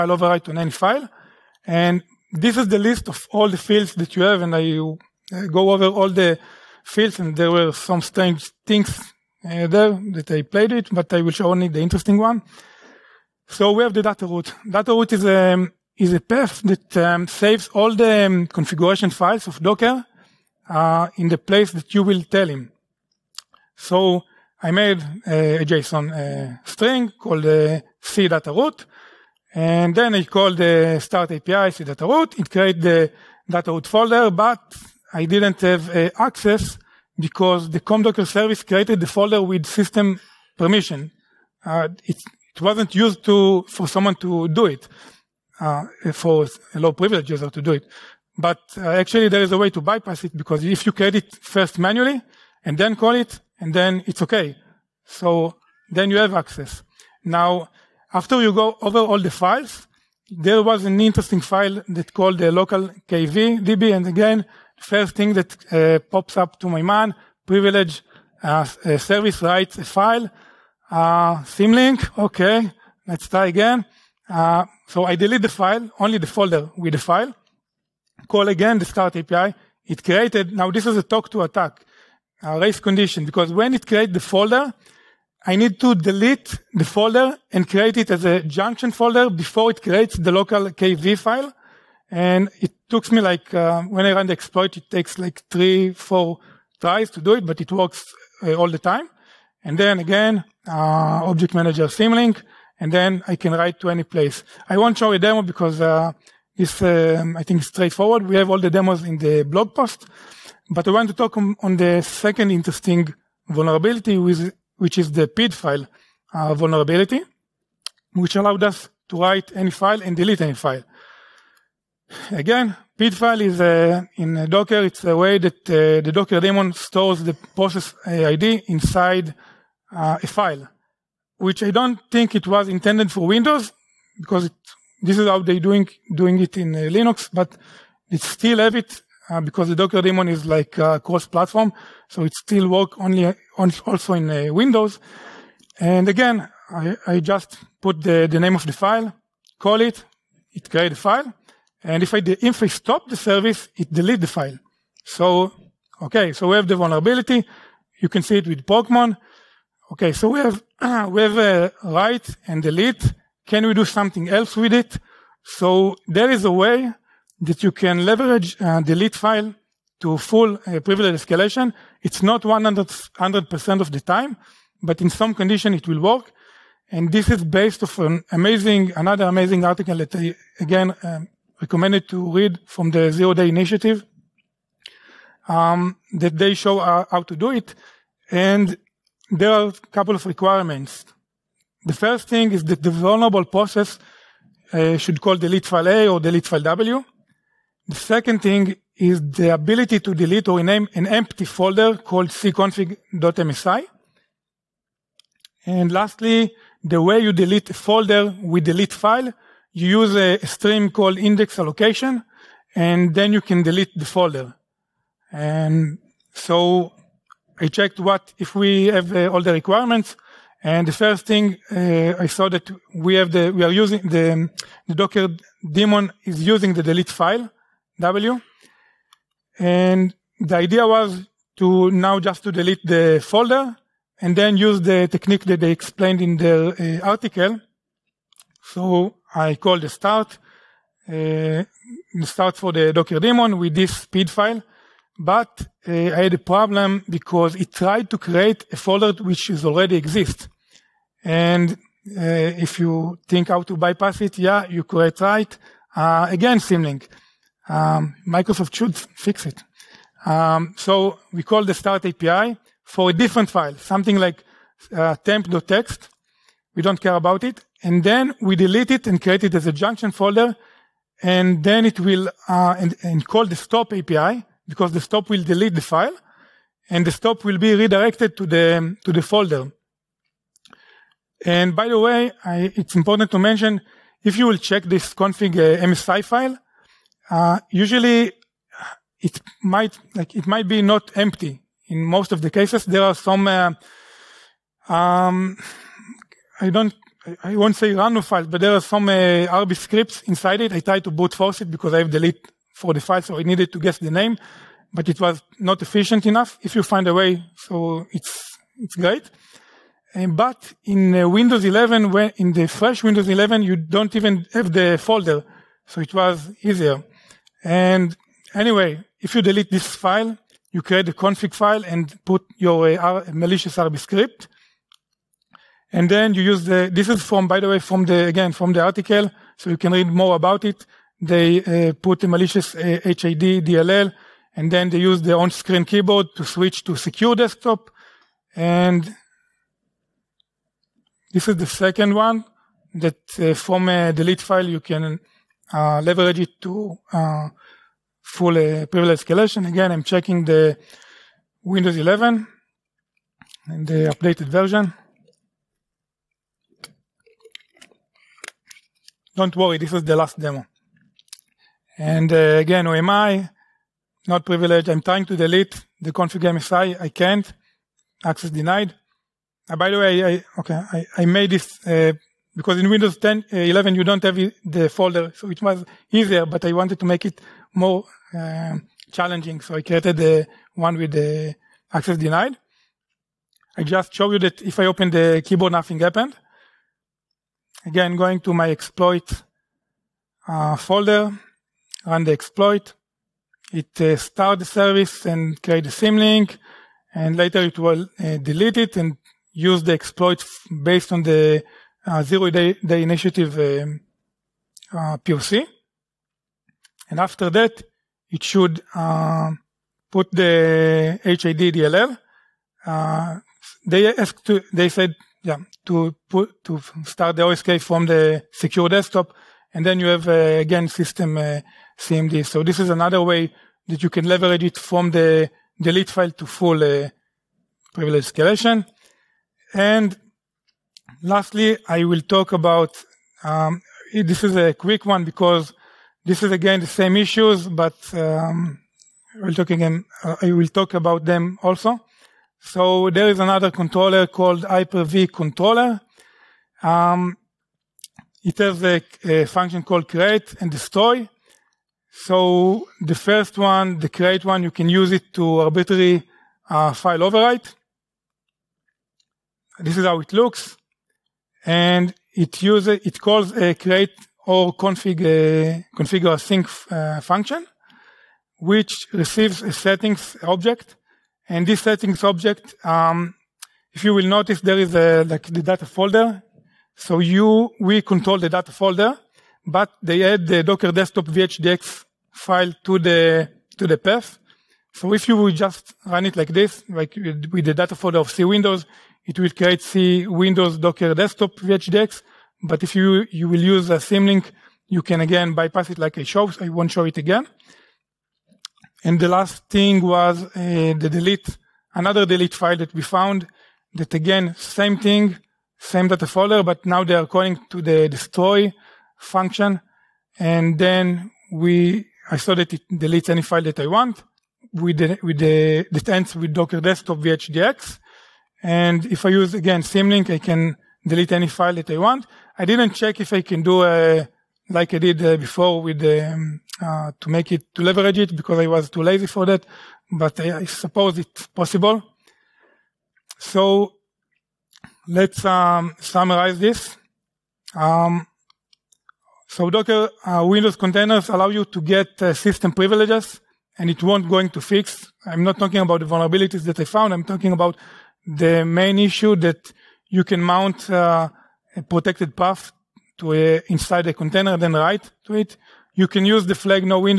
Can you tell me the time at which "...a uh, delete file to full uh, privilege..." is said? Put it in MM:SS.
02:48.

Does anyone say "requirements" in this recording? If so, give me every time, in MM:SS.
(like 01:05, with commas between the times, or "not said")
03:10, 03:39.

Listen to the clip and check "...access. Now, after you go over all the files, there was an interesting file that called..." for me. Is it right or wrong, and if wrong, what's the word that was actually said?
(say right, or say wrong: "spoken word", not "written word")
right.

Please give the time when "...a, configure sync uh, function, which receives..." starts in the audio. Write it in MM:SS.
07:45.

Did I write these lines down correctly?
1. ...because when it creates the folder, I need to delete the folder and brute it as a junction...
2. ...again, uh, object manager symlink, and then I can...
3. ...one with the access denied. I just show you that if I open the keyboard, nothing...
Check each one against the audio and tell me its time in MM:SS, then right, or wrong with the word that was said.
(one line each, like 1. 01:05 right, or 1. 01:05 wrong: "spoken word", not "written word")
1. 01:23 wrong: "create", not "brute"
2. 01:39 right
3. 06:20 right.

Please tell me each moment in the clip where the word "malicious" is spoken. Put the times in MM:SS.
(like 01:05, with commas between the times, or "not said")
05:23, 05:32.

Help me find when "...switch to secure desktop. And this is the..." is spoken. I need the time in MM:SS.
05:36.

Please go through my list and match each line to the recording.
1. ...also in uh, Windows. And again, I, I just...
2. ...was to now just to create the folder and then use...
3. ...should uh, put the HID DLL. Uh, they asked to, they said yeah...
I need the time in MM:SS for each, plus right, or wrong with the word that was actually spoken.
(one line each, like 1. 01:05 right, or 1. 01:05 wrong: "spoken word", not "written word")
1. 02:23 right
2. 03:50 wrong: "delete", not "create"
3. 06:48 right.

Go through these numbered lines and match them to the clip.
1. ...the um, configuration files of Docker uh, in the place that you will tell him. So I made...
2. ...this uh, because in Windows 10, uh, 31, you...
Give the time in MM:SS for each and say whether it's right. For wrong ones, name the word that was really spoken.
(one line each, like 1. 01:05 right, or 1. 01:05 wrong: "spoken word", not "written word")
1. 00:17 right
2. 06:11 wrong: "11", not "31".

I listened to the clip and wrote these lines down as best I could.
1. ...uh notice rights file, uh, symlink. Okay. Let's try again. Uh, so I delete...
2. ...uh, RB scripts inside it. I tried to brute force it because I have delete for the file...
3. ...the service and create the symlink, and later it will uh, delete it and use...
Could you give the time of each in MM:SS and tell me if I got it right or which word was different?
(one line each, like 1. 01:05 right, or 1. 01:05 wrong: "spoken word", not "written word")
1. 01:08 wrong: "service", not "notice"
2. 04:59 right
3. 06:34 right.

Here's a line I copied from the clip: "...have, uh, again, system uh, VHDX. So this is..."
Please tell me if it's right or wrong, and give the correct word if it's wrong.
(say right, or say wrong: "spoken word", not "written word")
wrong: "CMD", not "VHDX".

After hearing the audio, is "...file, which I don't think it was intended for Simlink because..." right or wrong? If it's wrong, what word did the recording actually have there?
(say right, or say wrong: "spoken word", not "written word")
wrong: "Windows", not "Simlink".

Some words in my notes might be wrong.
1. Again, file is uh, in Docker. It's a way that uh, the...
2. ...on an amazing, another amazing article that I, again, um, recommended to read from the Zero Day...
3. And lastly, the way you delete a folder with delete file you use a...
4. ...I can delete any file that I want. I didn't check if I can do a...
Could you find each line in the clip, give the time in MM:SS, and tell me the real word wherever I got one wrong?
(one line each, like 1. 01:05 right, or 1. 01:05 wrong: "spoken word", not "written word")
1. 02:02 right
2. 02:57 right
3. 03:25 right
4. 08:40 right.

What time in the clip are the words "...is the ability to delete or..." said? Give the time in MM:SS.
03:18.